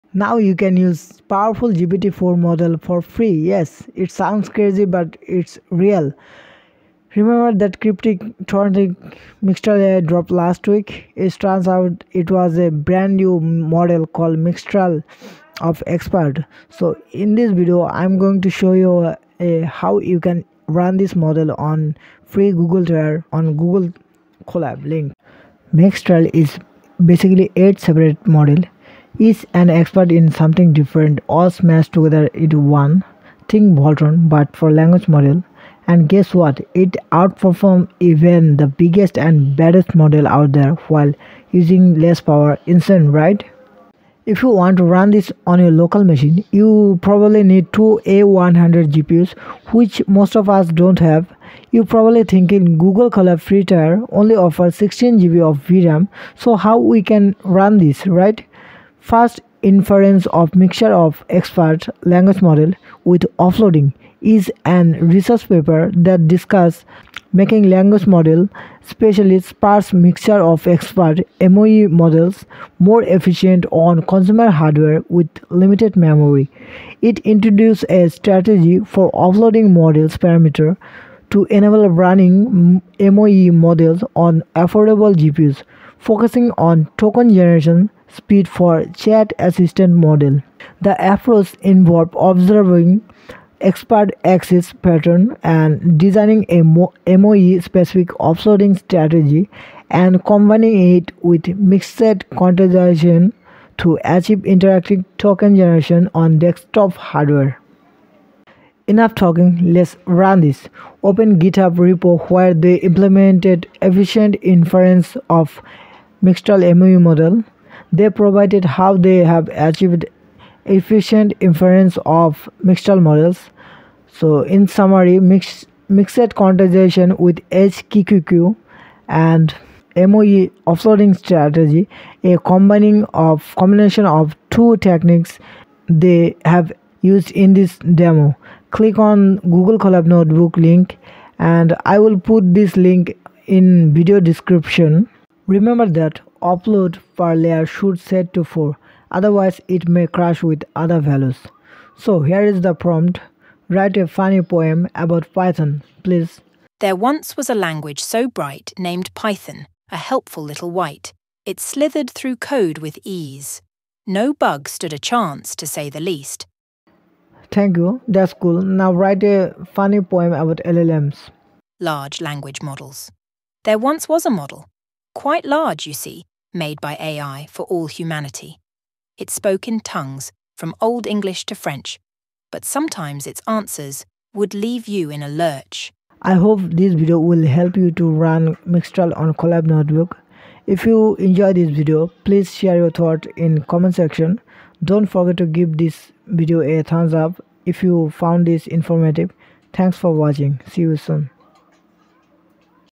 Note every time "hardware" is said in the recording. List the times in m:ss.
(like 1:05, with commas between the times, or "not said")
1:14, 1:46.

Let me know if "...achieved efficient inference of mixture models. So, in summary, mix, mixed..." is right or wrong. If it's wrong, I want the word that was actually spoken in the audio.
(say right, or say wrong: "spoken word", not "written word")
right.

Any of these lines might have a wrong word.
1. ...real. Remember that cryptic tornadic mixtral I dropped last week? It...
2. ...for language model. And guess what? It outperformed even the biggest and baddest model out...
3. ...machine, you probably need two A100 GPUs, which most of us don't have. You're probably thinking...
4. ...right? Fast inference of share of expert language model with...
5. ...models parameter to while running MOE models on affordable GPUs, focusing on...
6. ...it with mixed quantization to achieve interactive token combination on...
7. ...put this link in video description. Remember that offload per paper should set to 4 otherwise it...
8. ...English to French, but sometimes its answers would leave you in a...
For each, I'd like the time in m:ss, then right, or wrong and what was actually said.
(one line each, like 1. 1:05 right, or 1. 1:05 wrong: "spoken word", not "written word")
1. 0:05 right
2. 0:34 right
3. 0:46 right
4. 0:58 wrong: "mixture", not "share"
5. 1:19 wrong: "enable", not "while"
6. 1:40 wrong: "generation", not "combination"
7. 2:22 wrong: "layer", not "paper"
8. 3:01 right.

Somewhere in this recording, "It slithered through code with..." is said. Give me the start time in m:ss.
2:41.